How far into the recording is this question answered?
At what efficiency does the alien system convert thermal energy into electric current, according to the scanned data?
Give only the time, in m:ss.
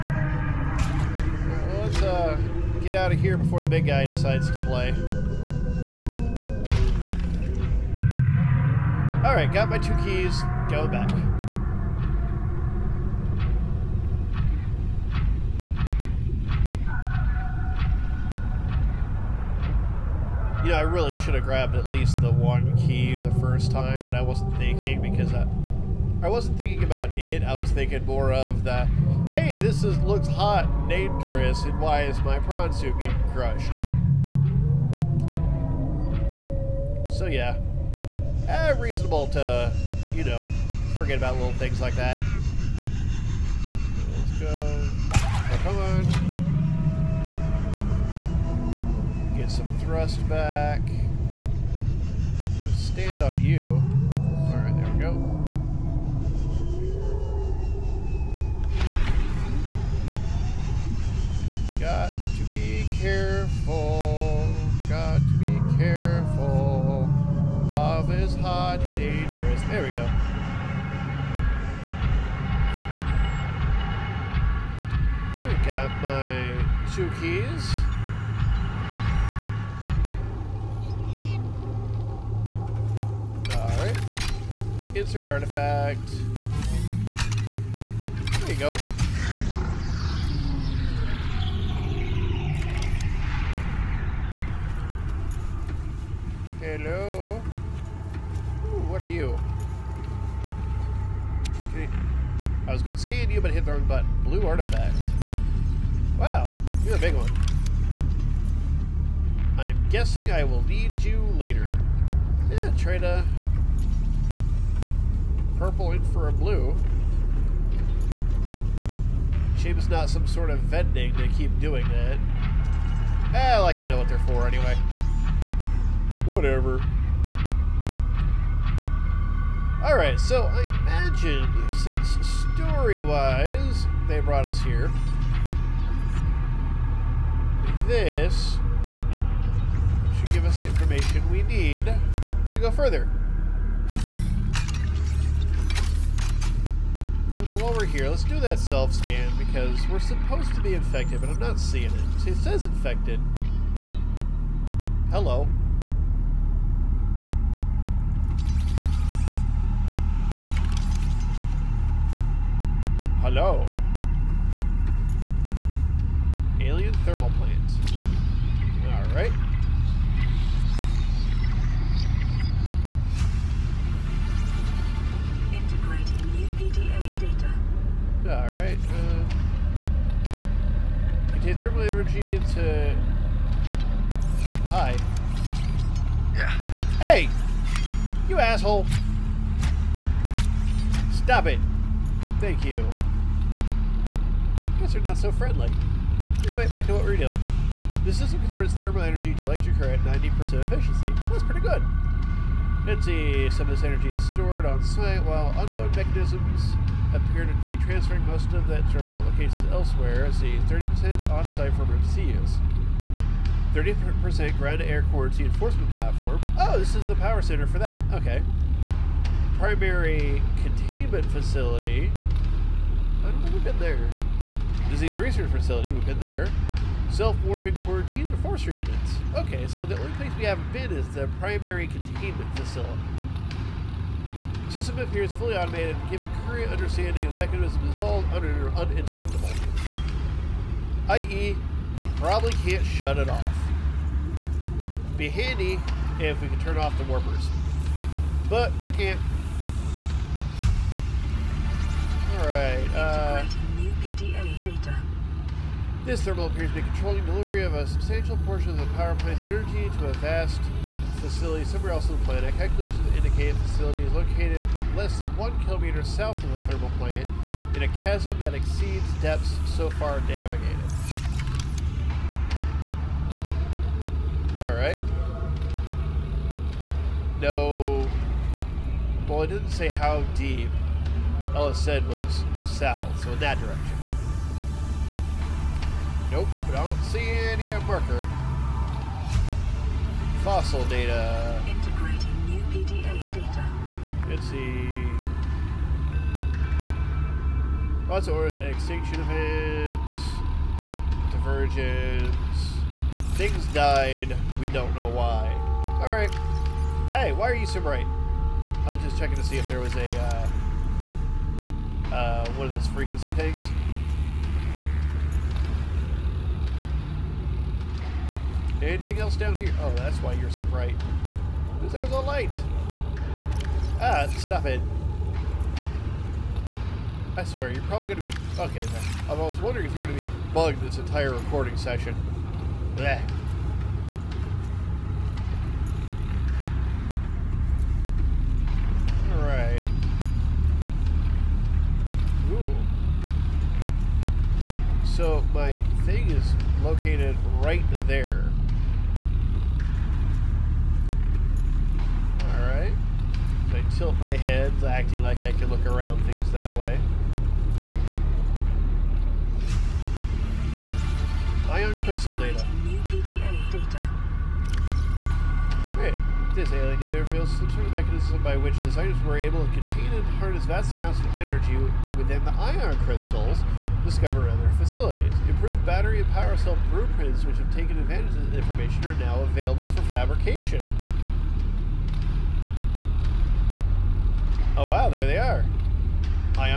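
3:20.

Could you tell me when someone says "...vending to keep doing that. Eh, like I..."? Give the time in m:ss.
2:00.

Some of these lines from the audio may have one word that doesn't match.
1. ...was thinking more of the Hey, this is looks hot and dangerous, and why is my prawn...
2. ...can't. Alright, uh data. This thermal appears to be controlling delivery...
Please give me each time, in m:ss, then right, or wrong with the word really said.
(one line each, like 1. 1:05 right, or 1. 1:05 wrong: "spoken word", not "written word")
1. 0:27 right
2. 4:08 right.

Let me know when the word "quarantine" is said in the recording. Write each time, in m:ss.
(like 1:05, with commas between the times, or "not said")
3:35, 3:47.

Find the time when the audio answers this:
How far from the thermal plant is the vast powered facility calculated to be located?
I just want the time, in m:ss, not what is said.
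4:24.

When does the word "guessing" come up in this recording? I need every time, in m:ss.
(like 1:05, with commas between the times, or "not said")
1:49.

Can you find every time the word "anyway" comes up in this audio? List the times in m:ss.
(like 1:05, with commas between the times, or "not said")
2:04, 3:16.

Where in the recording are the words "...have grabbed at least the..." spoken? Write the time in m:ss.
0:21.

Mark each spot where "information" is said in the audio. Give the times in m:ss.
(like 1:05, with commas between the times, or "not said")
2:20, 6:18.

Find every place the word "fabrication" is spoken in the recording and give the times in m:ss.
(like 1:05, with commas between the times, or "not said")
6:20.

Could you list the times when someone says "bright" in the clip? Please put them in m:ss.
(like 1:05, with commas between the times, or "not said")
5:07, 5:20.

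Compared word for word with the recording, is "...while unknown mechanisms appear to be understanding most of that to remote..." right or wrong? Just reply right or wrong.
wrong.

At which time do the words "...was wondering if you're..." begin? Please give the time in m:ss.
5:29.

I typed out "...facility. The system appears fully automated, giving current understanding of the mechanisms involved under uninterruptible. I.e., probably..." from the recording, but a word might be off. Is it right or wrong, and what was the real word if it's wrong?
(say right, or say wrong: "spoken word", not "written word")
right.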